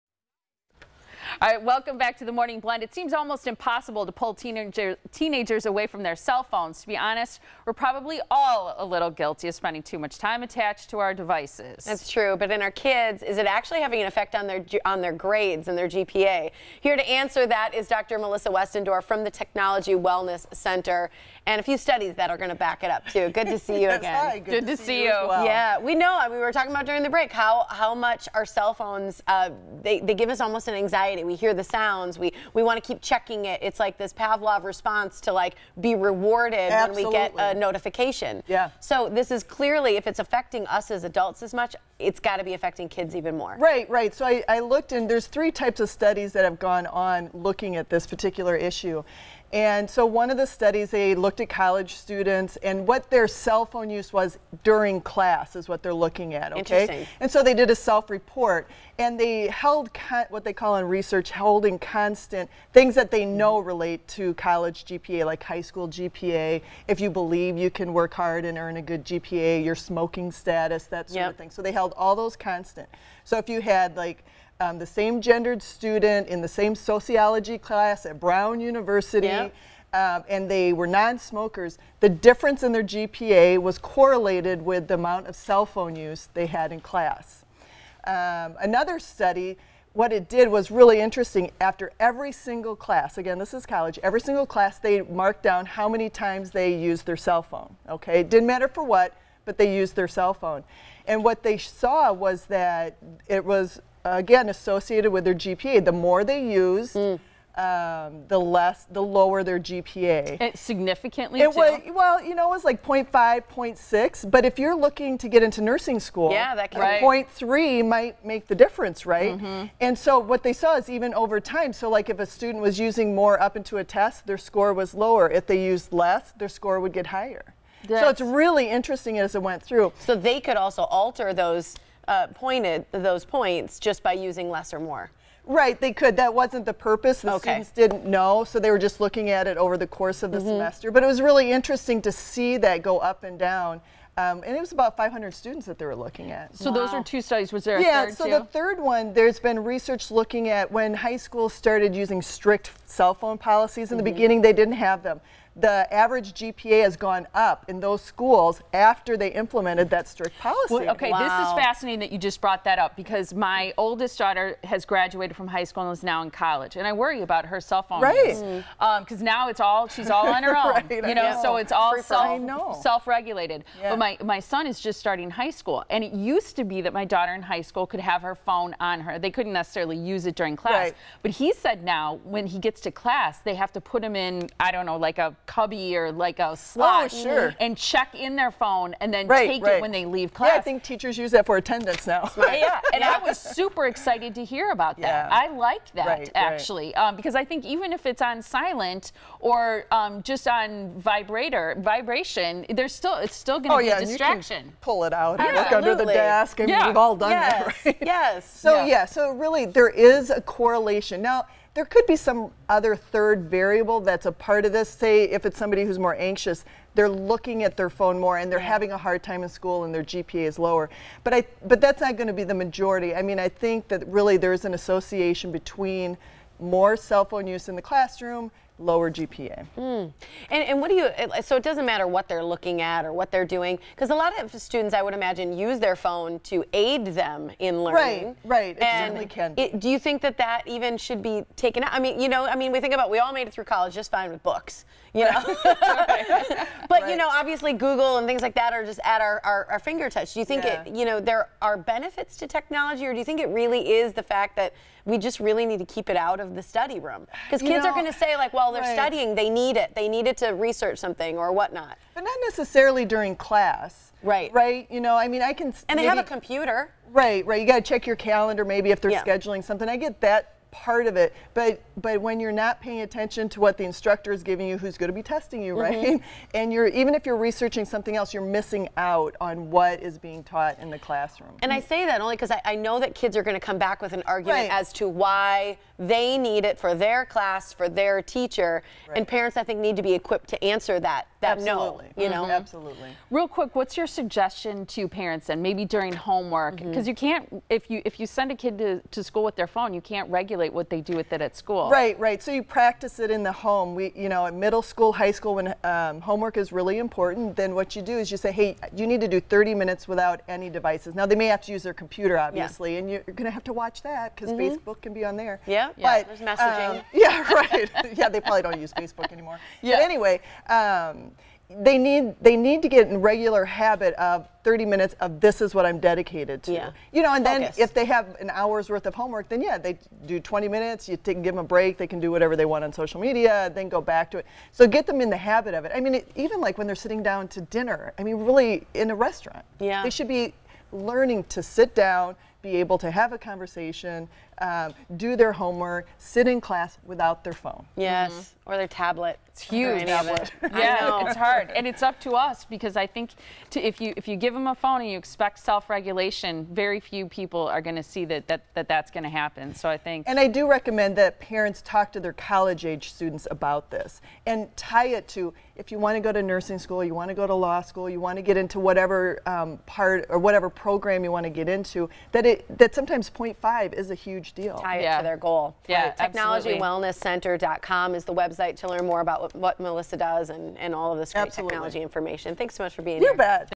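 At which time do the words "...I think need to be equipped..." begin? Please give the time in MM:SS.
04:49.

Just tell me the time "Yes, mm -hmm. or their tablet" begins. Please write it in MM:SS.
05:47.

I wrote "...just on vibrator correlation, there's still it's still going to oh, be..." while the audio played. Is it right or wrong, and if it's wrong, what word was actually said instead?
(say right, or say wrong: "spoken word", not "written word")
wrong: "vibration", not "correlation".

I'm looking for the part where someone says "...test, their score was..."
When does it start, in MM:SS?
02:03.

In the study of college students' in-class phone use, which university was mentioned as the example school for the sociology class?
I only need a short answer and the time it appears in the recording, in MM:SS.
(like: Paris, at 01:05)
Brown University, at 01:18.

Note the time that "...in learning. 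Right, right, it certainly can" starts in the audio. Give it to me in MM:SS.
03:57.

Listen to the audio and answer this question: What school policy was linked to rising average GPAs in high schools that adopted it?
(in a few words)
strict cell phone policies.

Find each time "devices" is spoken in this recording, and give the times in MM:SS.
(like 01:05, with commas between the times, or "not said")
00:11, 05:10.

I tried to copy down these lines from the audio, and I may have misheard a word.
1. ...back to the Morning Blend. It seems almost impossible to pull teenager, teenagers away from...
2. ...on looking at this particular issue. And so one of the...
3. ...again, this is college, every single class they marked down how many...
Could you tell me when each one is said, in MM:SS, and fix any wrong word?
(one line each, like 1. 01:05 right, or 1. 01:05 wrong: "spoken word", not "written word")
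1. 00:01 right
2. 00:46 right
3. 01:33 right.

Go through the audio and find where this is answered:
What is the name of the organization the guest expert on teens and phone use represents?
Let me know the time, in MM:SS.
00:19.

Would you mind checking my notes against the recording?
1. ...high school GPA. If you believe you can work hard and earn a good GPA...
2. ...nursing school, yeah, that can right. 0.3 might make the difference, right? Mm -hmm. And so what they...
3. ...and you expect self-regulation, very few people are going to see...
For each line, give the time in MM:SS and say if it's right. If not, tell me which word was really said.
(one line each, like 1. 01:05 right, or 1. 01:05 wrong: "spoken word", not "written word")
1. 01:05 right
2. 01:55 right
3. 05:55 right.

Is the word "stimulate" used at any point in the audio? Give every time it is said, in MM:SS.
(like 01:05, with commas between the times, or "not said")
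not said.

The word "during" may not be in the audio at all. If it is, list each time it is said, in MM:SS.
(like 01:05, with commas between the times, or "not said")
00:26, 00:54, 03:00, 04:23, 04:55.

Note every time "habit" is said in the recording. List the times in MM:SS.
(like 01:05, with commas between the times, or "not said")
05:23, 05:35.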